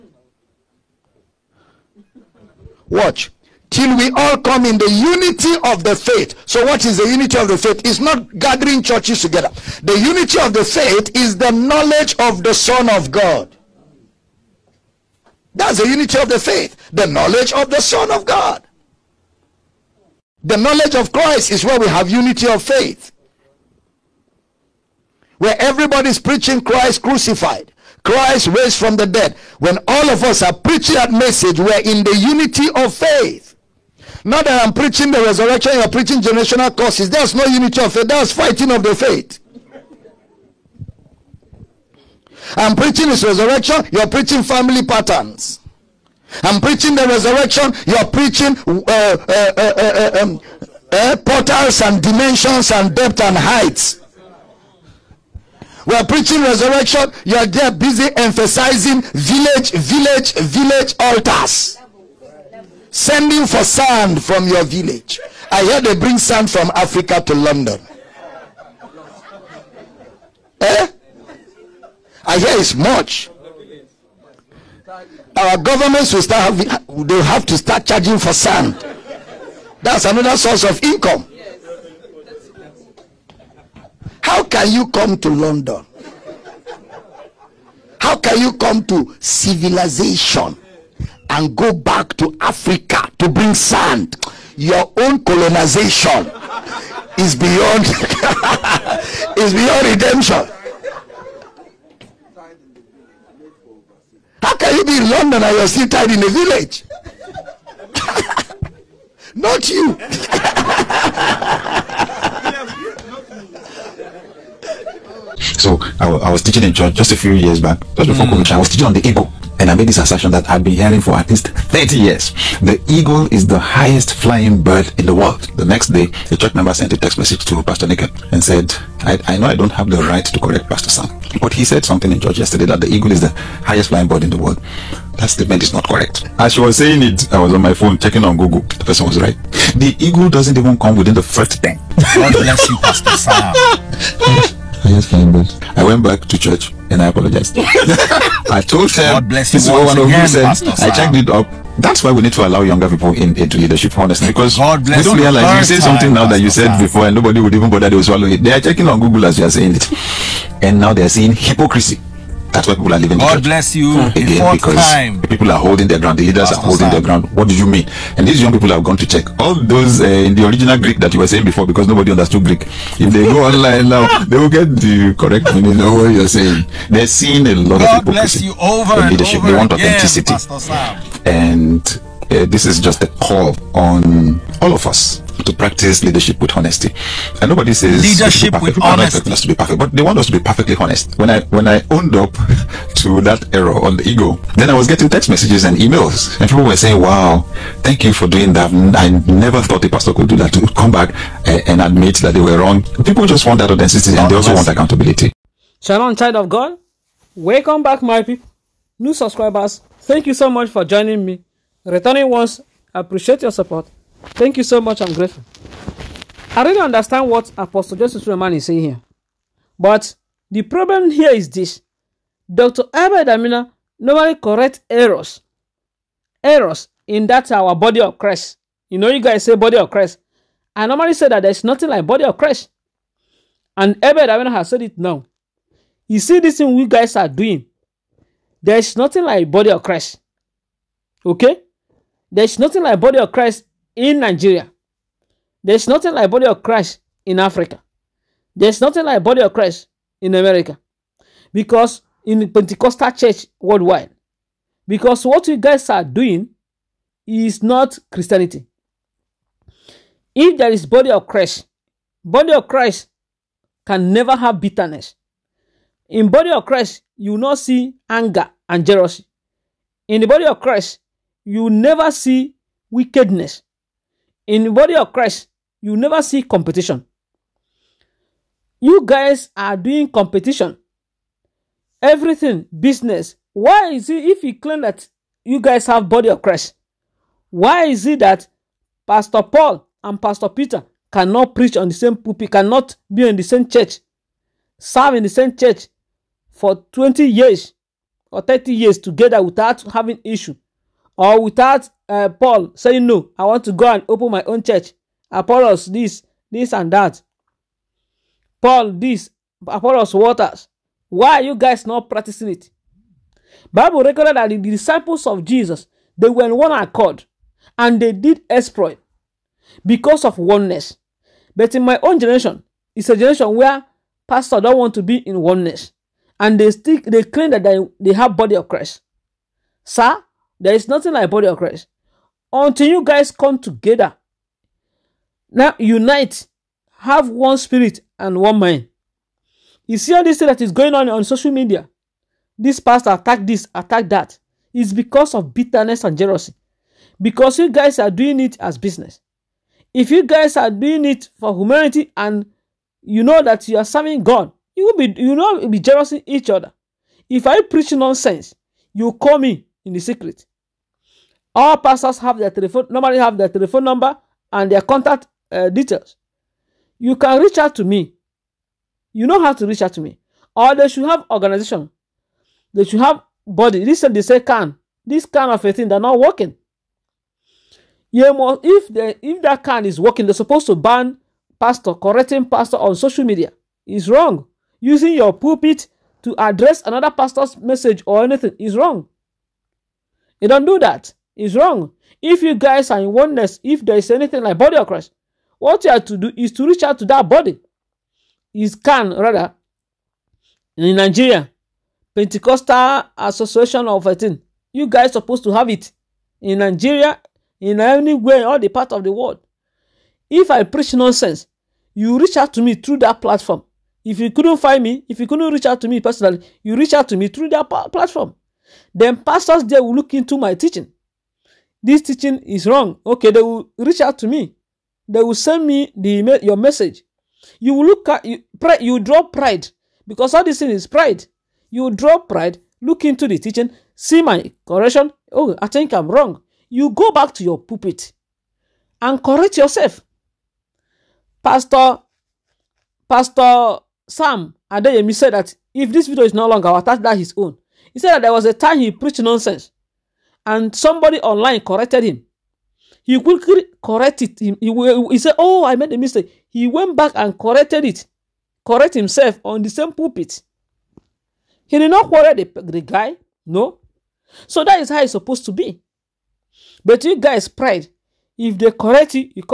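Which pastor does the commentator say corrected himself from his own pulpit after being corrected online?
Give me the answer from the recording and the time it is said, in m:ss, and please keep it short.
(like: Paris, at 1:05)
Pastor Sam Adeyemi, at 7:23.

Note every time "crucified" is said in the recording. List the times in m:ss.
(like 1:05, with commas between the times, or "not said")
0:27.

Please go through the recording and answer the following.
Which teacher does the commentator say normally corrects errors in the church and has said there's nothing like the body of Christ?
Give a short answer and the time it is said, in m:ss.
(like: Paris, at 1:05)
Dr. Abed Amina, at 3:42.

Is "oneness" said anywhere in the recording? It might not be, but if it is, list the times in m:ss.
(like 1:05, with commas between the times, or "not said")
5:20, 5:25, 6:33.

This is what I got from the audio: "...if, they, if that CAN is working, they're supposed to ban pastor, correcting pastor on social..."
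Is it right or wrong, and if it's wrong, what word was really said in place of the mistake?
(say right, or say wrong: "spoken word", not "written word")
right.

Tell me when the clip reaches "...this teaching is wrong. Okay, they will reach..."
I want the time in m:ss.
7:01.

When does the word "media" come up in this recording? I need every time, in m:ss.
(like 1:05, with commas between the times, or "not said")
5:41, 6:23.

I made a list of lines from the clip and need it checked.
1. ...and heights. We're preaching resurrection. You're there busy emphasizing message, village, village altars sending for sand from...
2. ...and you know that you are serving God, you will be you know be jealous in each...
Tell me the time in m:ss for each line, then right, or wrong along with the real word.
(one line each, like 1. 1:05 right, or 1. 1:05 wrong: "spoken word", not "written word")
1. 0:53 wrong: "village", not "message"
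2. 5:52 right.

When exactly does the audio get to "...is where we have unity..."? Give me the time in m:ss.
0:21.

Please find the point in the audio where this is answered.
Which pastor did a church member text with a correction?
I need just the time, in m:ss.
2:07.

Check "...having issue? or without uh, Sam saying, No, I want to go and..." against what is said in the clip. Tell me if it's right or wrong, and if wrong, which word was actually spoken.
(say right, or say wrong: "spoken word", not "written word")
wrong: "Paul", not "Sam".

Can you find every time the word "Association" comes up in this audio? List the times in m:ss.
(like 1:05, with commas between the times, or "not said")
6:43.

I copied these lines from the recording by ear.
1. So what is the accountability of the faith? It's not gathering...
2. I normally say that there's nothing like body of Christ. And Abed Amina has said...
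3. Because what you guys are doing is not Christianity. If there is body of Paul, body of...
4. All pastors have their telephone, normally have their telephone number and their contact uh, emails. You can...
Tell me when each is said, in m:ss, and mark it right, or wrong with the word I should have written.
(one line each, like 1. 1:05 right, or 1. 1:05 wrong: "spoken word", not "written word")
1. 0:06 wrong: "unity", not "accountability"
2. 3:50 right
3. 4:14 wrong: "Christ", not "Paul"
4. 6:01 wrong: "details", not "emails".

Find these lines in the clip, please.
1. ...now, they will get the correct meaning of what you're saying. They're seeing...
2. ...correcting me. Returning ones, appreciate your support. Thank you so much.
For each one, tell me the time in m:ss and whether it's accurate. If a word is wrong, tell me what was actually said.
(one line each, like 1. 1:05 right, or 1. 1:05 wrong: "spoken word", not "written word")
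1. 2:53 right
2. 3:30 wrong: "joining", not "correcting".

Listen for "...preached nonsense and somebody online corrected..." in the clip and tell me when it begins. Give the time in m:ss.
7:28.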